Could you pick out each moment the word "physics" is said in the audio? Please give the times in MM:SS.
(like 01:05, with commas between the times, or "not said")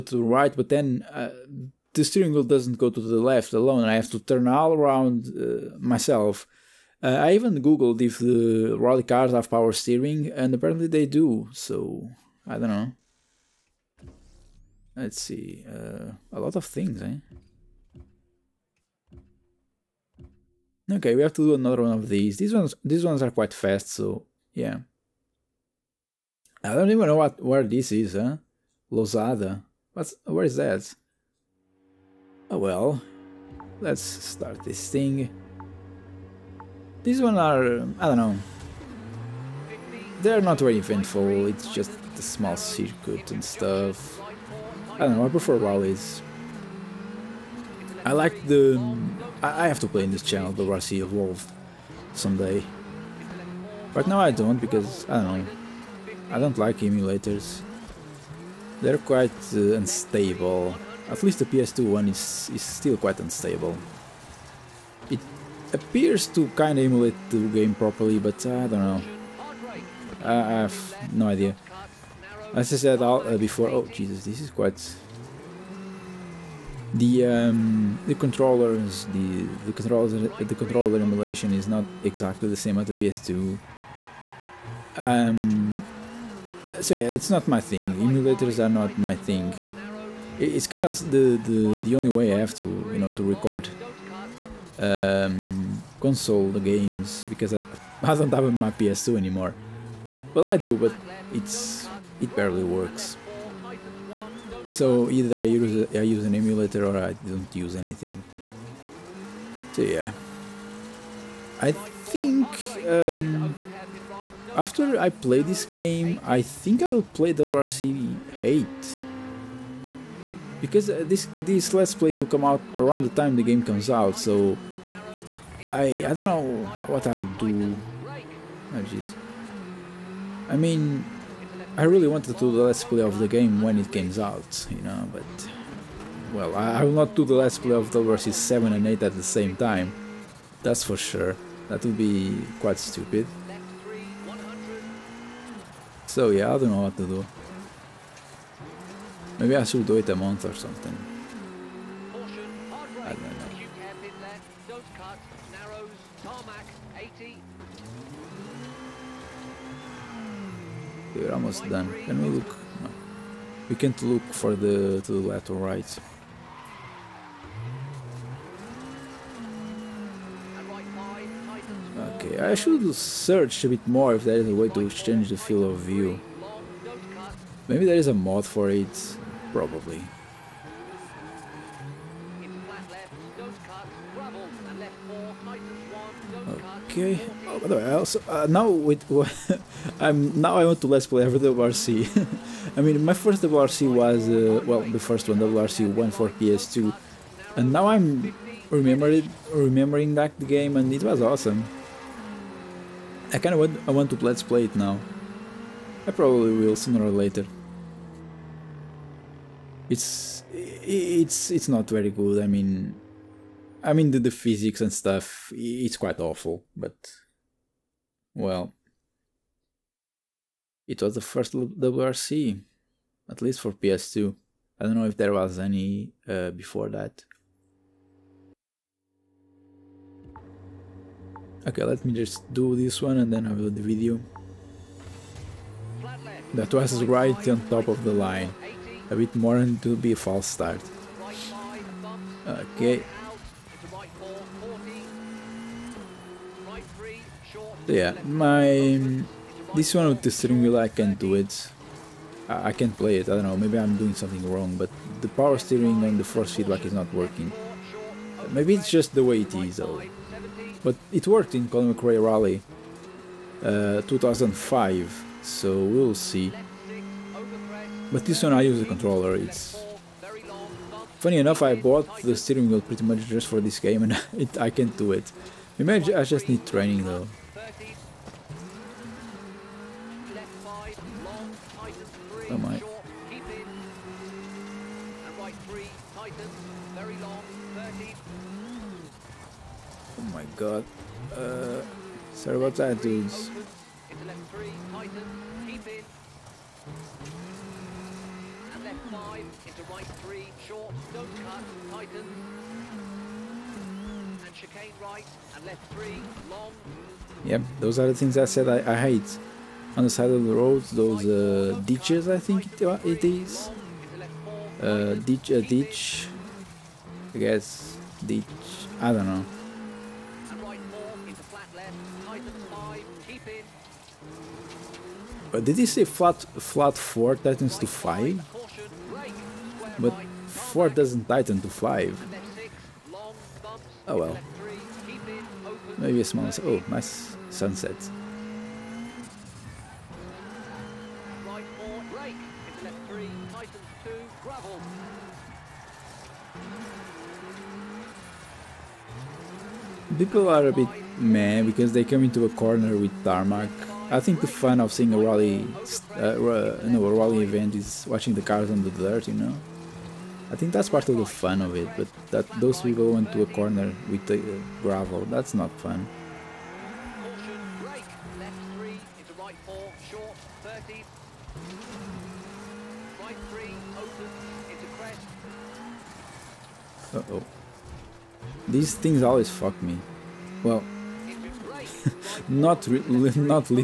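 03:34.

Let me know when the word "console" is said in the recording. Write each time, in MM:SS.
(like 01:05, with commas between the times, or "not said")
01:35.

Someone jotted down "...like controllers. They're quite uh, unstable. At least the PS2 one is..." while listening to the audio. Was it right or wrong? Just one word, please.
wrong.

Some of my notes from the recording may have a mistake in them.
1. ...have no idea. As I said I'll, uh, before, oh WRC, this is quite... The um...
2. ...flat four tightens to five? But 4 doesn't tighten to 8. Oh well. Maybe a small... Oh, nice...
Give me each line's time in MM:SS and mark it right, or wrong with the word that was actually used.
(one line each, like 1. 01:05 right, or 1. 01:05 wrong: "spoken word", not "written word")
1. 01:10 wrong: "Jesus", not "WRC"
2. 05:26 wrong: "5", not "8".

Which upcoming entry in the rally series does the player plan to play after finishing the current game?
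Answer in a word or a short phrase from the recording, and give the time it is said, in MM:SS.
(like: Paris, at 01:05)
WRC 8, at 01:57.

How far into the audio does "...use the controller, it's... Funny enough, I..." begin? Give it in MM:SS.
04:28.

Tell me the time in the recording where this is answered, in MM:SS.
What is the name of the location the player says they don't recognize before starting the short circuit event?
00:28.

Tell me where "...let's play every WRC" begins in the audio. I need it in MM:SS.
03:10.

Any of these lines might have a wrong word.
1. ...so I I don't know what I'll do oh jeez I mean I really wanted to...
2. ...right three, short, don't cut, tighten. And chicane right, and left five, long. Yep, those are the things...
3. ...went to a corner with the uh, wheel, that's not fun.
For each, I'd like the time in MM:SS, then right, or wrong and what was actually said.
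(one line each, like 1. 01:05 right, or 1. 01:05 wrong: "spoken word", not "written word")
1. 02:04 right
2. 04:59 wrong: "three", not "five"
3. 06:03 wrong: "gravel", not "wheel".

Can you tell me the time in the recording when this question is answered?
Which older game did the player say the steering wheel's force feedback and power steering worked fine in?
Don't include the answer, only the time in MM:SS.
04:21.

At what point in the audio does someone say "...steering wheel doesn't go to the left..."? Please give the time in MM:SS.
00:02.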